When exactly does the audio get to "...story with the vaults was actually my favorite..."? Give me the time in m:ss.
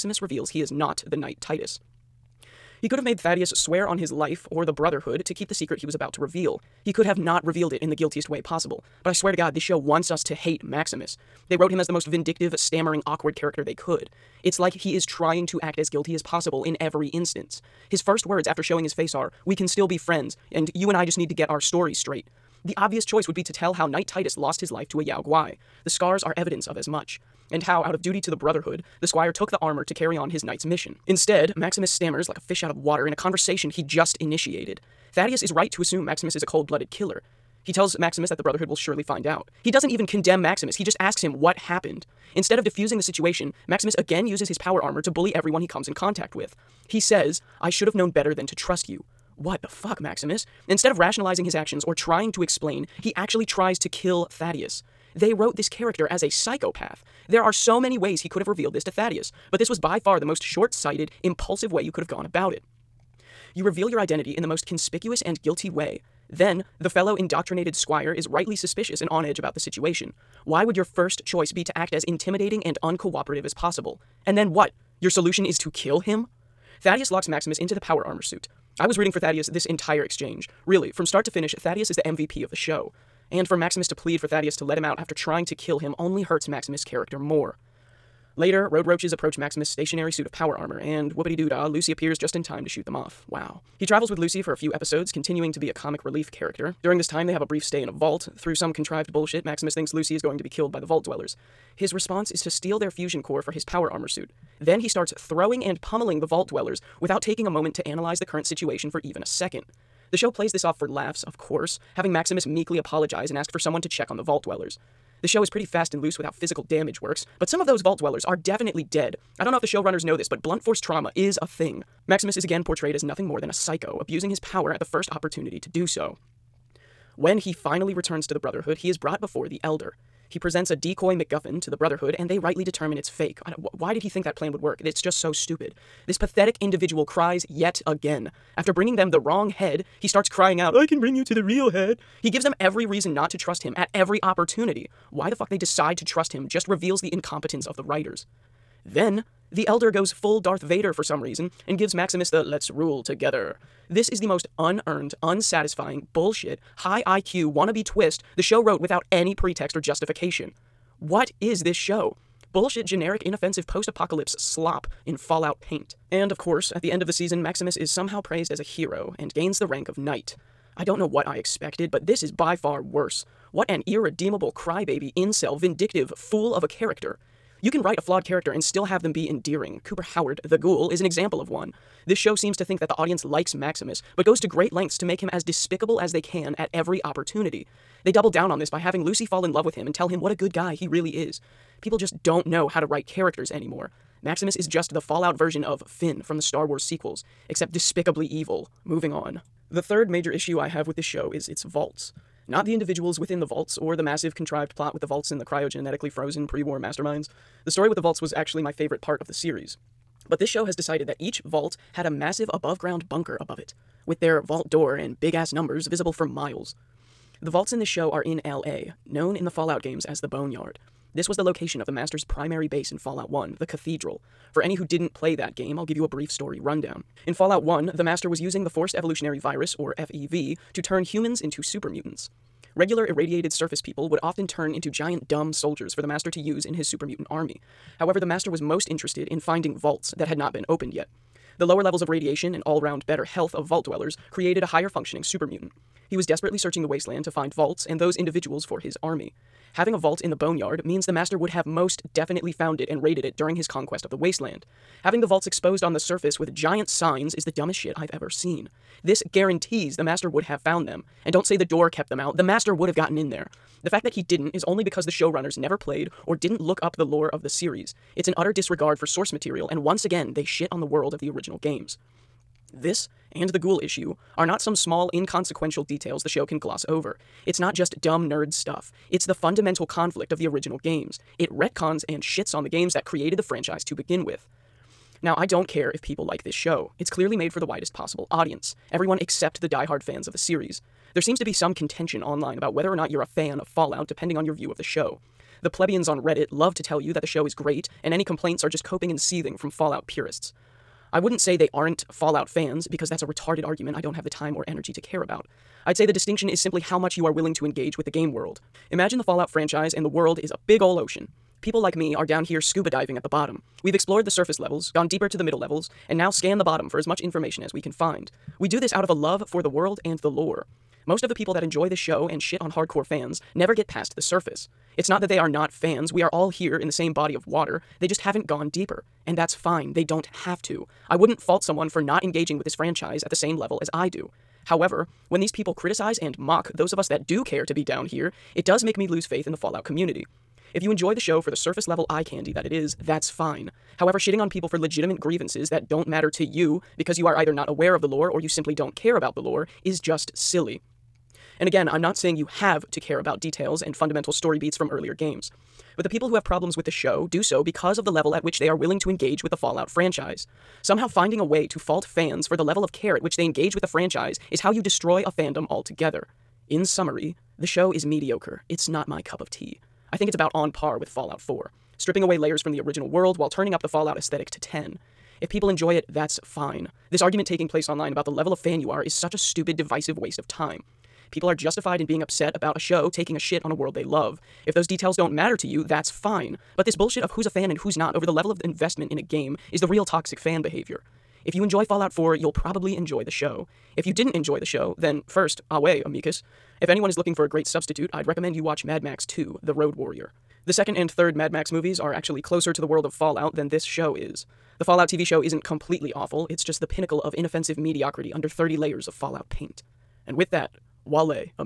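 3:27.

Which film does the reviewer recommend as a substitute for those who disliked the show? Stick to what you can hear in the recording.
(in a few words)
Mad Max 2 The Road Warrior.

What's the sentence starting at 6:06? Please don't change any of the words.
In summary, the show is mediocre.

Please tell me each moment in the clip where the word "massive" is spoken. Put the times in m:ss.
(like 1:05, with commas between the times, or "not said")
3:24, 3:32.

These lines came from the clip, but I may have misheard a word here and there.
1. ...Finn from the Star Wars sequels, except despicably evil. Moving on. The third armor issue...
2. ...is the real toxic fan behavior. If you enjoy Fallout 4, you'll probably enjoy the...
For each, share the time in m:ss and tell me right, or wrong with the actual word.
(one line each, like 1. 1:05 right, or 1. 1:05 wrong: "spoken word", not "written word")
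1. 3:15 wrong: "major", not "armor"
2. 6:29 right.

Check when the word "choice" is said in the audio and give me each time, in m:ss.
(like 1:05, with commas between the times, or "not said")
0:23, 1:11.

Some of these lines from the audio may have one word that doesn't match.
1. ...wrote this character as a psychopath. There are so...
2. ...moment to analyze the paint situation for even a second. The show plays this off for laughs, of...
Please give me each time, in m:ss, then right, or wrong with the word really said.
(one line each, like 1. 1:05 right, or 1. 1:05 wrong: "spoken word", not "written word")
1. 0:55 right
2. 1:47 wrong: "current", not "paint".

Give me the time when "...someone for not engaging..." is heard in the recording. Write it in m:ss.
5:31.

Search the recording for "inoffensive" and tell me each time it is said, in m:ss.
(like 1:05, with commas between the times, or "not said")
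2:43, 6:47.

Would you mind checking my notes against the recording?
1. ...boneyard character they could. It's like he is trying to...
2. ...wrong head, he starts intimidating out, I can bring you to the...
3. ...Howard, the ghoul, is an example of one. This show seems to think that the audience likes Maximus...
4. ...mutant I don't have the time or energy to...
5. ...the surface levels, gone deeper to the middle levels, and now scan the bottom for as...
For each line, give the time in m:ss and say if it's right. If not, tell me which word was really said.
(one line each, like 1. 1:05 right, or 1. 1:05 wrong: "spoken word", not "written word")
1. 0:13 wrong: "awkward", not "boneyard"
2. 2:19 wrong: "crying", not "intimidating"
3. 3:00 right
4. 5:03 wrong: "argument", not "mutant"
5. 5:14 right.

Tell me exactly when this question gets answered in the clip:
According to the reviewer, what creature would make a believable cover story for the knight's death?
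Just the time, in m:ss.
0:25.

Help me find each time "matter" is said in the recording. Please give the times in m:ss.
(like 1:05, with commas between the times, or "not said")
5:46, 6:25.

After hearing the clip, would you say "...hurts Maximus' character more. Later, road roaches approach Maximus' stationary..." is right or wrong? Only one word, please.
right.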